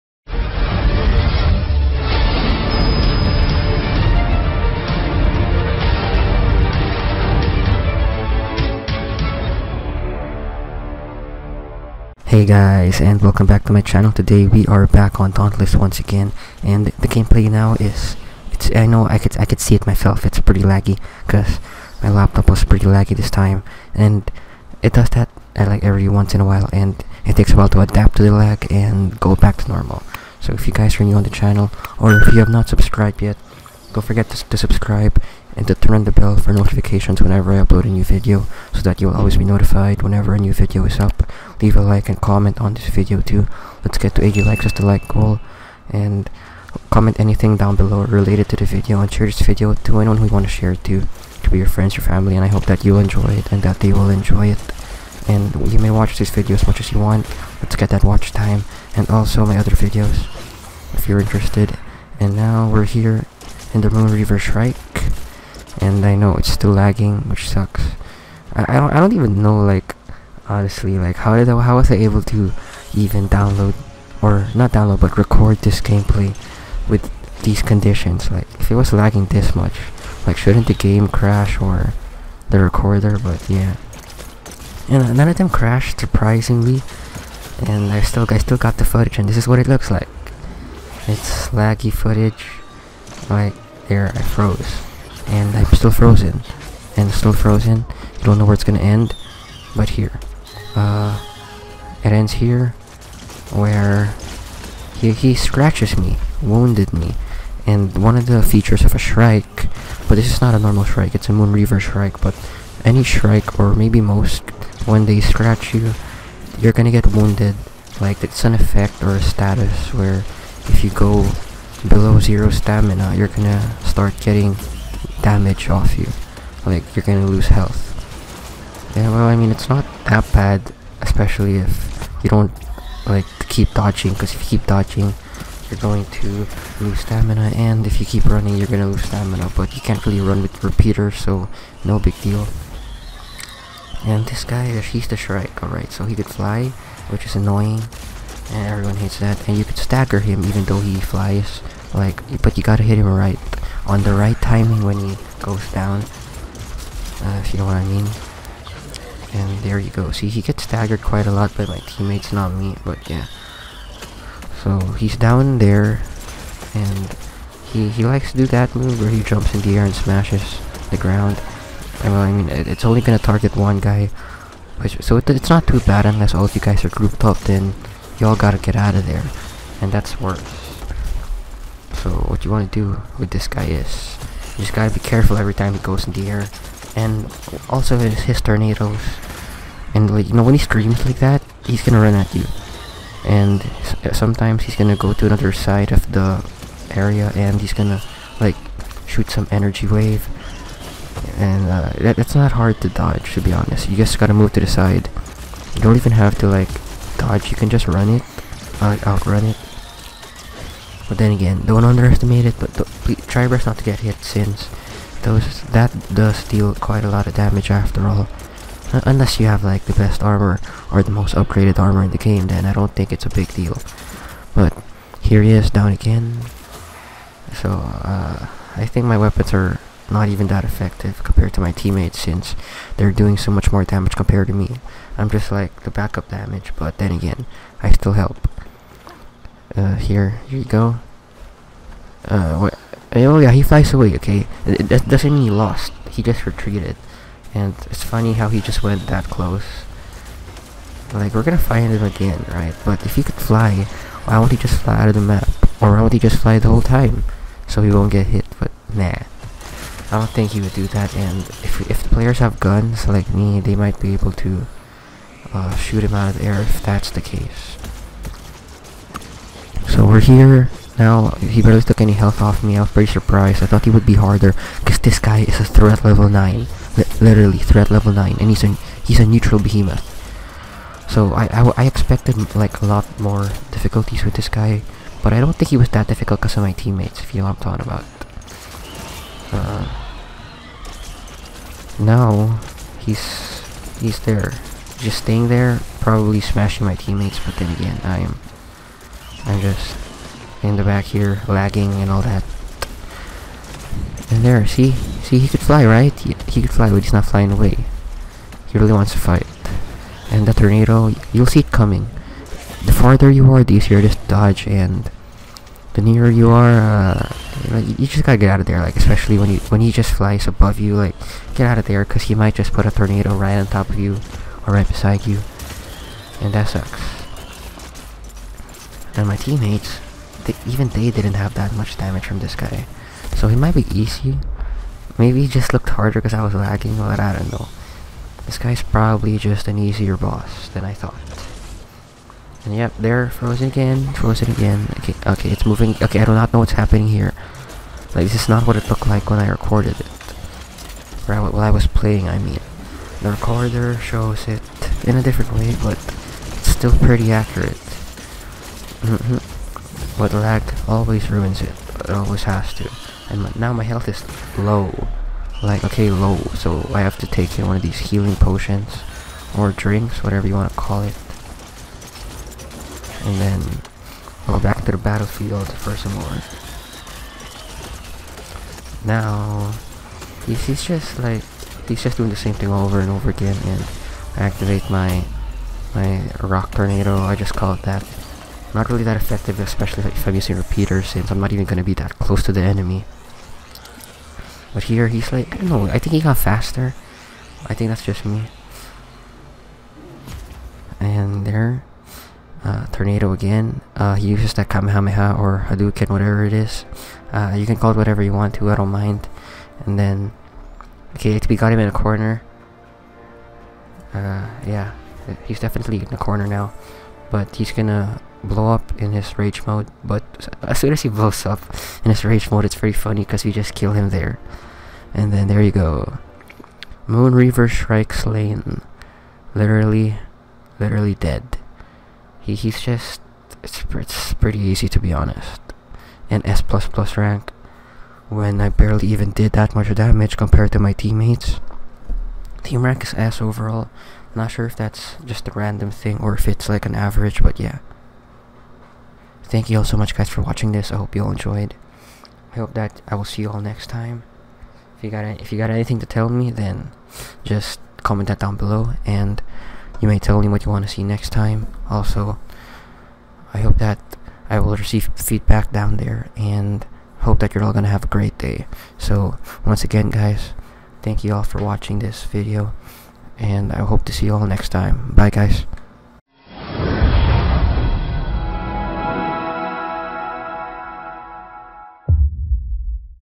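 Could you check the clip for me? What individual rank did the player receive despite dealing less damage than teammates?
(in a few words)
S plus plus.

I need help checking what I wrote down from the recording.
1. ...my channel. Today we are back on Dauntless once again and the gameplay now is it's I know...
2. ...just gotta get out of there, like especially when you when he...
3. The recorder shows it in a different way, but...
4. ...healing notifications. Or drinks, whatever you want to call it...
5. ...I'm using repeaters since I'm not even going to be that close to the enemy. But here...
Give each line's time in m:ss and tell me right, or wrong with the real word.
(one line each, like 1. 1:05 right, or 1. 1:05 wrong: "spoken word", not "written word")
1. 0:13 right
2. 5:18 right
3. 5:53 right
4. 6:08 wrong: "potions", not "notifications"
5. 6:30 right.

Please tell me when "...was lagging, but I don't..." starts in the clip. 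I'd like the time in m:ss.
5:36.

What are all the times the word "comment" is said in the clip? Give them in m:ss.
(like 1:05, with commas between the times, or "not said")
0:42, 0:46, 7:38.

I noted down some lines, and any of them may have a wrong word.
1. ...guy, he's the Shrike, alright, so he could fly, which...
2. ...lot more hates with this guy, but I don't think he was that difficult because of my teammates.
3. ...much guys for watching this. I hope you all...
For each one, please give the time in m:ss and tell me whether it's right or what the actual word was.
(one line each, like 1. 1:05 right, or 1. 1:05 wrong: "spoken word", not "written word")
1. 2:24 right
2. 4:42 wrong: "difficulties", not "hates"
3. 7:29 right.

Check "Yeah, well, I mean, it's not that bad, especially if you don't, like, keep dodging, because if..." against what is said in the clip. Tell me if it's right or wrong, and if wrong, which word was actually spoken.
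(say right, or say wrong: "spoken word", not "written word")
right.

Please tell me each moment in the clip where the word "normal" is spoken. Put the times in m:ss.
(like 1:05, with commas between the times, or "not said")
0:29, 1:50.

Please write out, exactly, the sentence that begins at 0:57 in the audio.
Let's get that watch time and also my other videos if you're interested.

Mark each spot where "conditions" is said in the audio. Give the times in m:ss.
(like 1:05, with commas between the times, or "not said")
1:17.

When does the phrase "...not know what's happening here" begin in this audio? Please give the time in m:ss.
5:46.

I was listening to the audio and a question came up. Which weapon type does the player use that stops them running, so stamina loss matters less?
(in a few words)
repeater.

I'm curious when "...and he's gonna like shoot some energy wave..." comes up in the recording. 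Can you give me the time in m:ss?
3:17.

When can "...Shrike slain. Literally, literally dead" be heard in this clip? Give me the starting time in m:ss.
7:07.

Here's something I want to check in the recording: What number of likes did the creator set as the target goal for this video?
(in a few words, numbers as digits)
80.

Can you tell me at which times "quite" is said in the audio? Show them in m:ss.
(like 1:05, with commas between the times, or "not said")
2:41, 3:36.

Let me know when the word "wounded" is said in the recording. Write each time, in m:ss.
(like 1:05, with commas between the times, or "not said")
1:46, 1:57.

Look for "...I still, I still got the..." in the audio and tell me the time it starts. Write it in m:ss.
1:27.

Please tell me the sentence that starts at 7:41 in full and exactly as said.
Also, I hope that I will receive feedback down there and hope that you're all going to have a great day.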